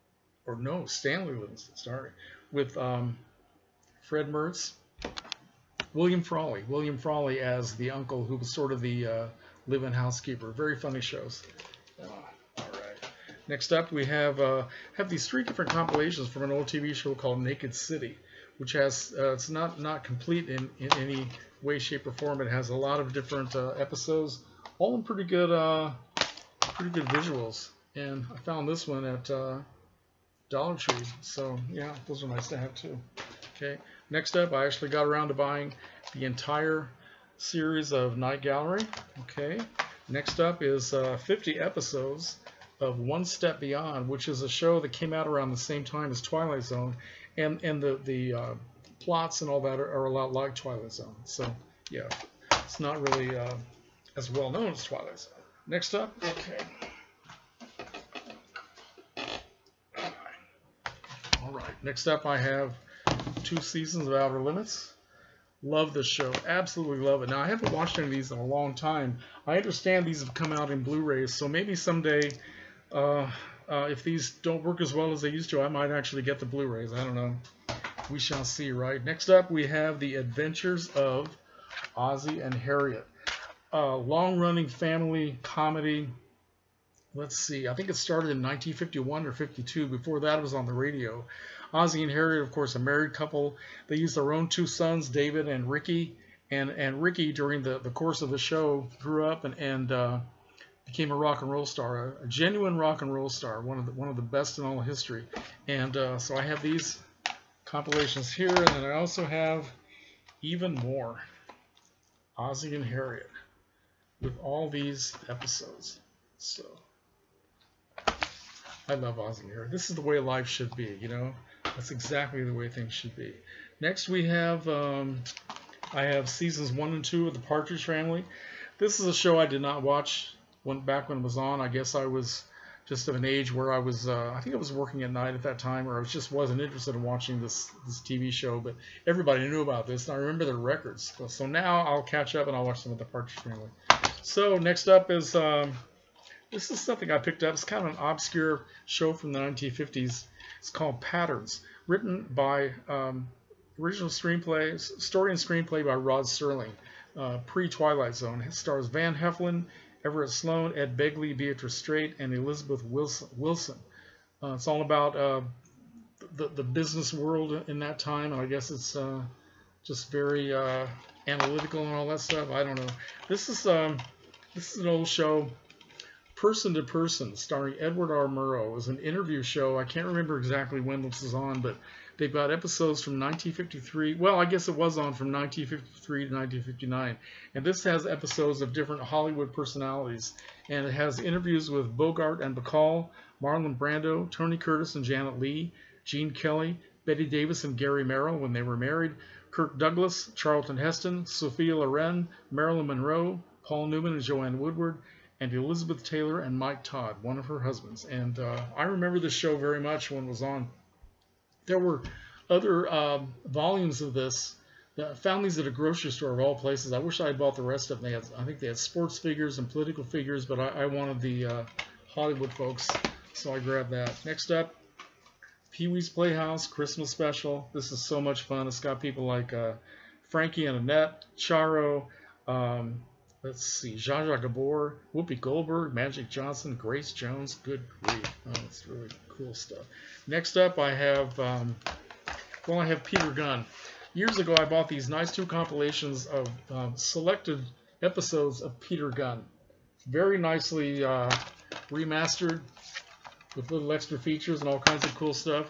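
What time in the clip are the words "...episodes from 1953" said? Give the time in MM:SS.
03:02.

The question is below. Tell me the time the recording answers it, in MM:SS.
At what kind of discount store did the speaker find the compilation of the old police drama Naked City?
00:30.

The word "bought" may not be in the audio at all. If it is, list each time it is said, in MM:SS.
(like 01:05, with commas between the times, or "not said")
03:37, 04:04.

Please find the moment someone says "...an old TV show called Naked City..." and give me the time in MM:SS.
00:16.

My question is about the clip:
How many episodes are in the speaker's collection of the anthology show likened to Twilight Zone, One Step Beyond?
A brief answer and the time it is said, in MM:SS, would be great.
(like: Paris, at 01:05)
50, at 00:41.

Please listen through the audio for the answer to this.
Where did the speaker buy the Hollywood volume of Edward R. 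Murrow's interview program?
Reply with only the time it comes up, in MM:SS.
03:35.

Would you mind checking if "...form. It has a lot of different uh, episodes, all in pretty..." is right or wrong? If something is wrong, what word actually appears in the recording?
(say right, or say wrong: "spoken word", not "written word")
right.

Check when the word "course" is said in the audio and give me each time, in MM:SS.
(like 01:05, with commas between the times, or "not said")
01:32, 01:37.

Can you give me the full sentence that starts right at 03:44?
Next up, Pee-wee's Playhouse Christmas Special.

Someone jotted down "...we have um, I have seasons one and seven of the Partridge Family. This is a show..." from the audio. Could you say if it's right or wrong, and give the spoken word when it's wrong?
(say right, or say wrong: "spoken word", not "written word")
wrong: "two", not "seven".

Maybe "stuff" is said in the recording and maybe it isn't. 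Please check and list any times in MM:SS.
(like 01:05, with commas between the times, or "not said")
02:52, 03:59.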